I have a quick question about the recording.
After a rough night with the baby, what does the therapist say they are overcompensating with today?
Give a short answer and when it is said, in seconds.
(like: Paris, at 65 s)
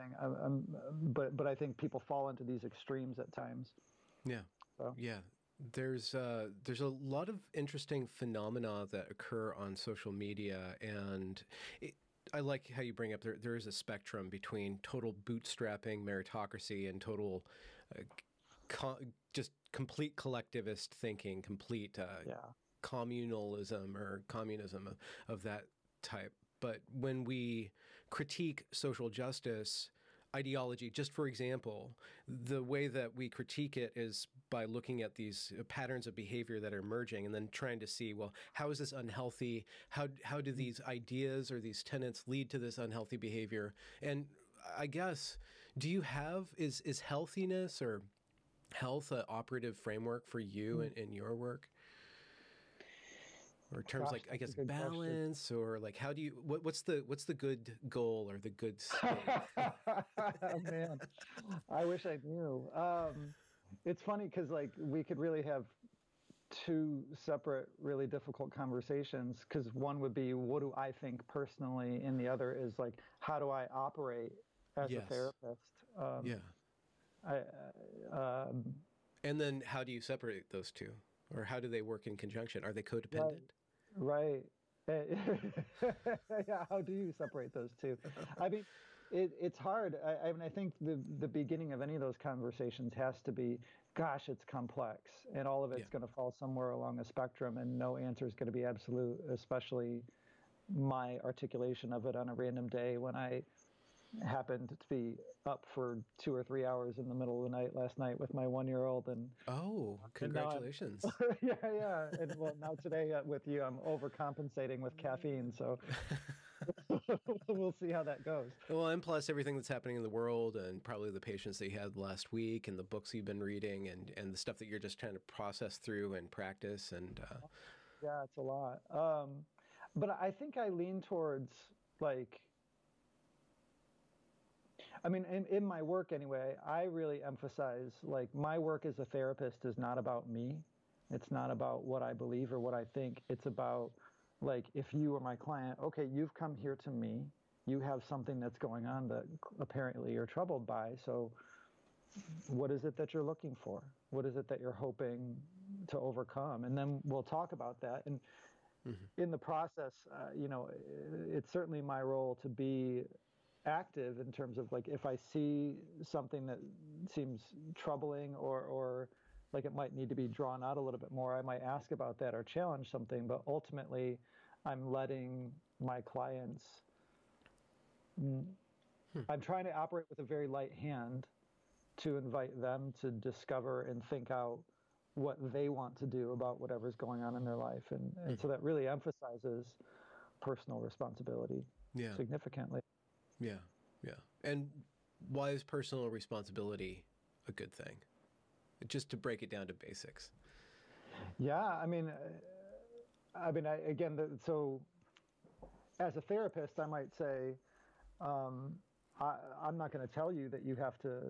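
caffeine, at 114 s.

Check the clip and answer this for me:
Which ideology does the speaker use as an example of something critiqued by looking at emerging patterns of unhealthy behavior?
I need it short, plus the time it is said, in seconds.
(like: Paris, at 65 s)
social justice ideology, at 28 s.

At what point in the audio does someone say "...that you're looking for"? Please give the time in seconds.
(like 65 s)
152 s.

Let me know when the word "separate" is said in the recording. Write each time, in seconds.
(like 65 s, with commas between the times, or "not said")
67 s, 80 s, 87 s.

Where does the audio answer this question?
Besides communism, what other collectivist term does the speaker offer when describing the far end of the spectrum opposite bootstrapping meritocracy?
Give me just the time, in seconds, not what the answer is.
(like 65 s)
22 s.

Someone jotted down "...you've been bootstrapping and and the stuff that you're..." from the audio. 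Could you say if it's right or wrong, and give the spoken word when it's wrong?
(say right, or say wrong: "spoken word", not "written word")
wrong: "reading", not "bootstrapping".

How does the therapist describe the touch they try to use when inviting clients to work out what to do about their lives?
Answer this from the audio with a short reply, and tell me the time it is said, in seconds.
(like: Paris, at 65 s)
a very light hand, at 180 s.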